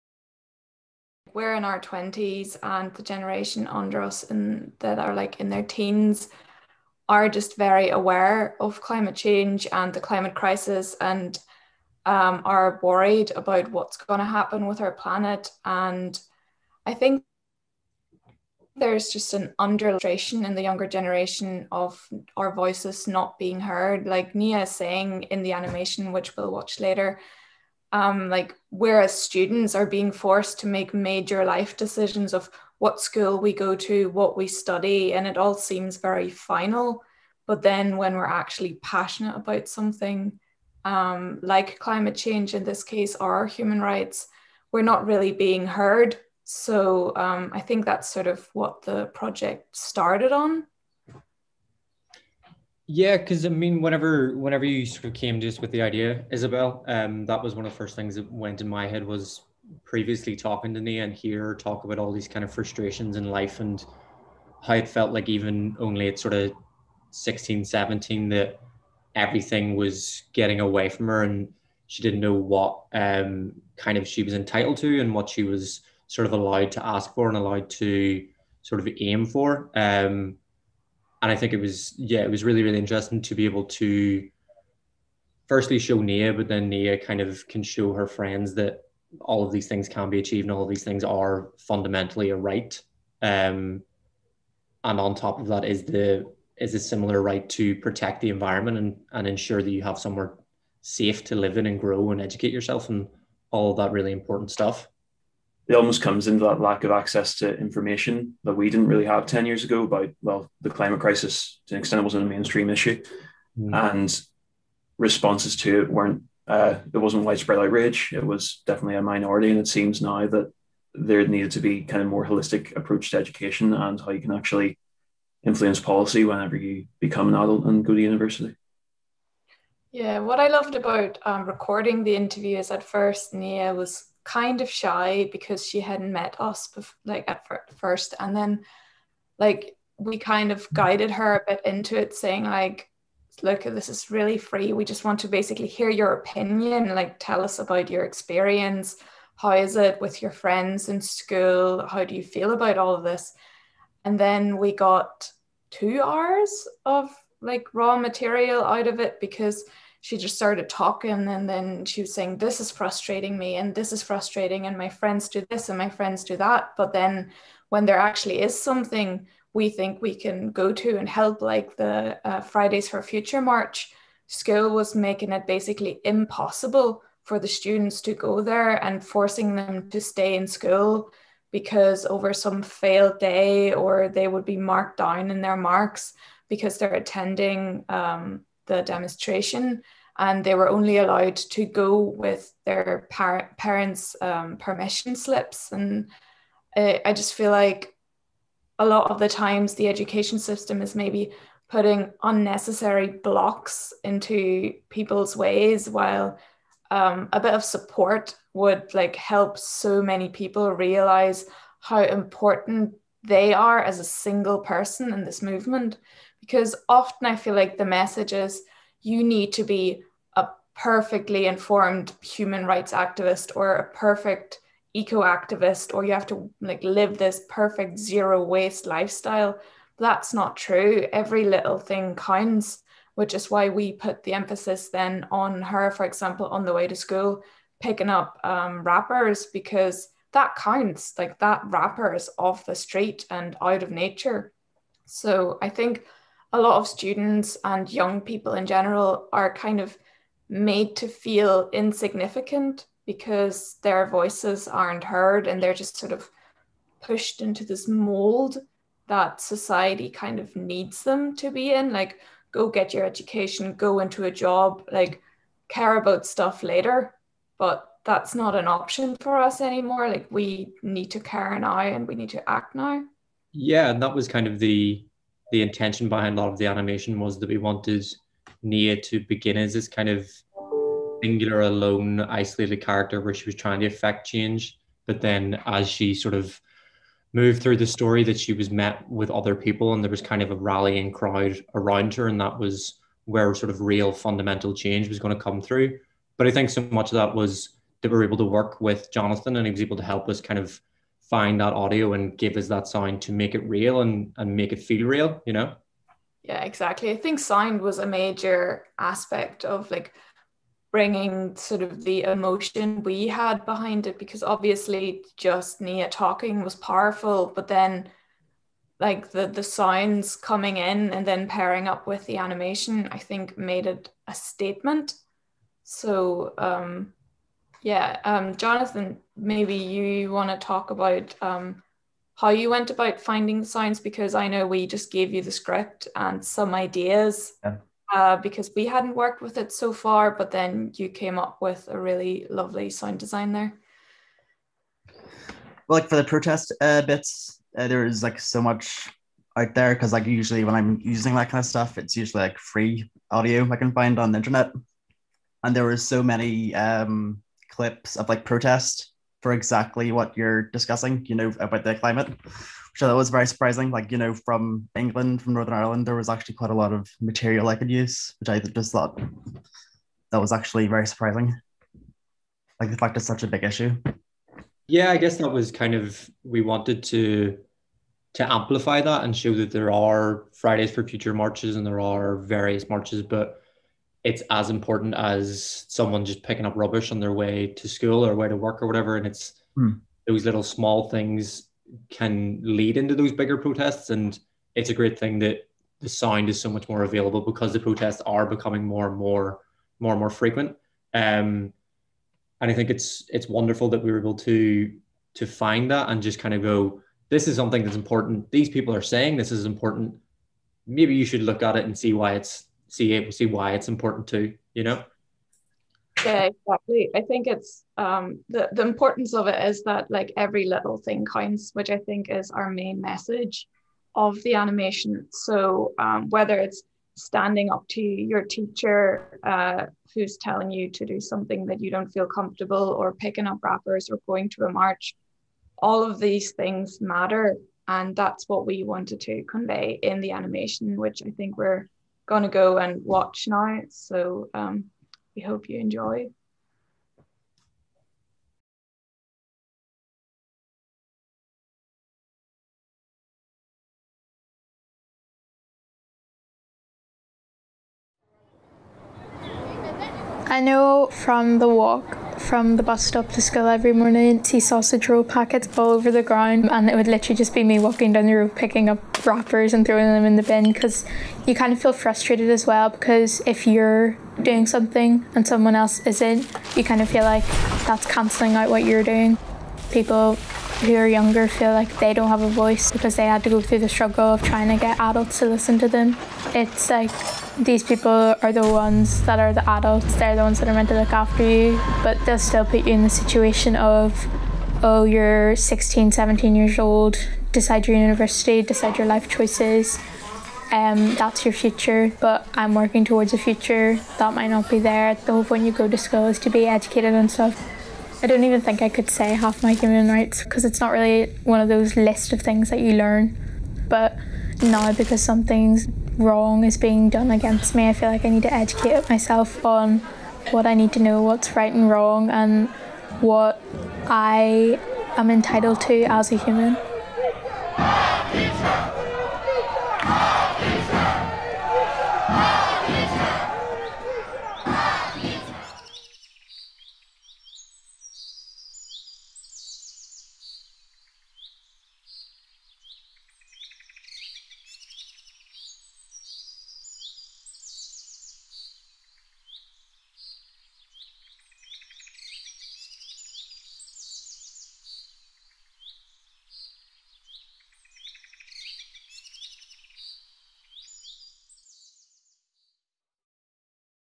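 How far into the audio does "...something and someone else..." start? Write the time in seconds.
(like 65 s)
474 s.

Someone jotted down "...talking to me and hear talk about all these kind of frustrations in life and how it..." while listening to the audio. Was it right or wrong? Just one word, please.
right.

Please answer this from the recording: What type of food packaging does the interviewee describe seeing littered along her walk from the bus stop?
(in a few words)
sausage roll packets.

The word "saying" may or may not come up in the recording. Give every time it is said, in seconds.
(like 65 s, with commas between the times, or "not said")
24 s, 142 s, 162 s, 409 s.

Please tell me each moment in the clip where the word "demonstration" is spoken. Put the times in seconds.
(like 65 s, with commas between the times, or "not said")
188 s.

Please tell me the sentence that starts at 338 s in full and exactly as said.
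uh, because we hadn't worked with it so far, but then you came up with a really lovely sound design there.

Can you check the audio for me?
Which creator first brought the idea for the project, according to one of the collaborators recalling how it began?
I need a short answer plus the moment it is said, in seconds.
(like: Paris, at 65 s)
Isabelle, at 56 s.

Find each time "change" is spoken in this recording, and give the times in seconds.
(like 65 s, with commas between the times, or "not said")
9 s, 42 s, 284 s, 294 s.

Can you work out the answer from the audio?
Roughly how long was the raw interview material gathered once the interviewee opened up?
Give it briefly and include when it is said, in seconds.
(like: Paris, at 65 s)
2 hours, at 155 s.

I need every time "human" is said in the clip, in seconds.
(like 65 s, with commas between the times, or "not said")
43 s, 222 s, 509 s, 526 s.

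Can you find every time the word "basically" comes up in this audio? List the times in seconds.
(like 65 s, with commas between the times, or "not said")
145 s, 175 s.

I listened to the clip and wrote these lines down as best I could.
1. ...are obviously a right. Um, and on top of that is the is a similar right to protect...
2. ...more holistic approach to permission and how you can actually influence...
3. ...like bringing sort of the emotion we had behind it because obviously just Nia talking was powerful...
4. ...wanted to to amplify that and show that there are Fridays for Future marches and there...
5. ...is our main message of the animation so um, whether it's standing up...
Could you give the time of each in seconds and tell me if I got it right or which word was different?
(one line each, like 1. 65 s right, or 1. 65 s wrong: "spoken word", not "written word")
1. 91 s wrong: "fundamentally", not "obviously"
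2. 122 s wrong: "education", not "permission"
3. 309 s right
4. 376 s right
5. 422 s right.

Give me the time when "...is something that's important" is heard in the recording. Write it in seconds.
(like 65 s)
407 s.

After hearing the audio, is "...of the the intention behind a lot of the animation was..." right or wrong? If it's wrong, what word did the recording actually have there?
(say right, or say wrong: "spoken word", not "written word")
right.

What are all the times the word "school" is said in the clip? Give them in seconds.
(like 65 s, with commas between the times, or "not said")
33 s, 151 s, 174 s, 180 s, 236 s, 387 s, 463 s, 505 s.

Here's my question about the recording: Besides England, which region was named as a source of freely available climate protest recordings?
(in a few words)
Northern Ireland.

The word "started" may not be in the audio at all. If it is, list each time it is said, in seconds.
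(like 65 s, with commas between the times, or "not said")
49 s, 160 s.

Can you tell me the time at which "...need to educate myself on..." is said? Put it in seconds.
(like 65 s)
518 s.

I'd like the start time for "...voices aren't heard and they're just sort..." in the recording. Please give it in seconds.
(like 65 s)
254 s.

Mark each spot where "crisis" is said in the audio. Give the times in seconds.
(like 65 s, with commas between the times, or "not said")
10 s, 110 s.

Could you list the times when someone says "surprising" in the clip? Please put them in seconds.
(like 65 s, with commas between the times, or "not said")
363 s, 371 s.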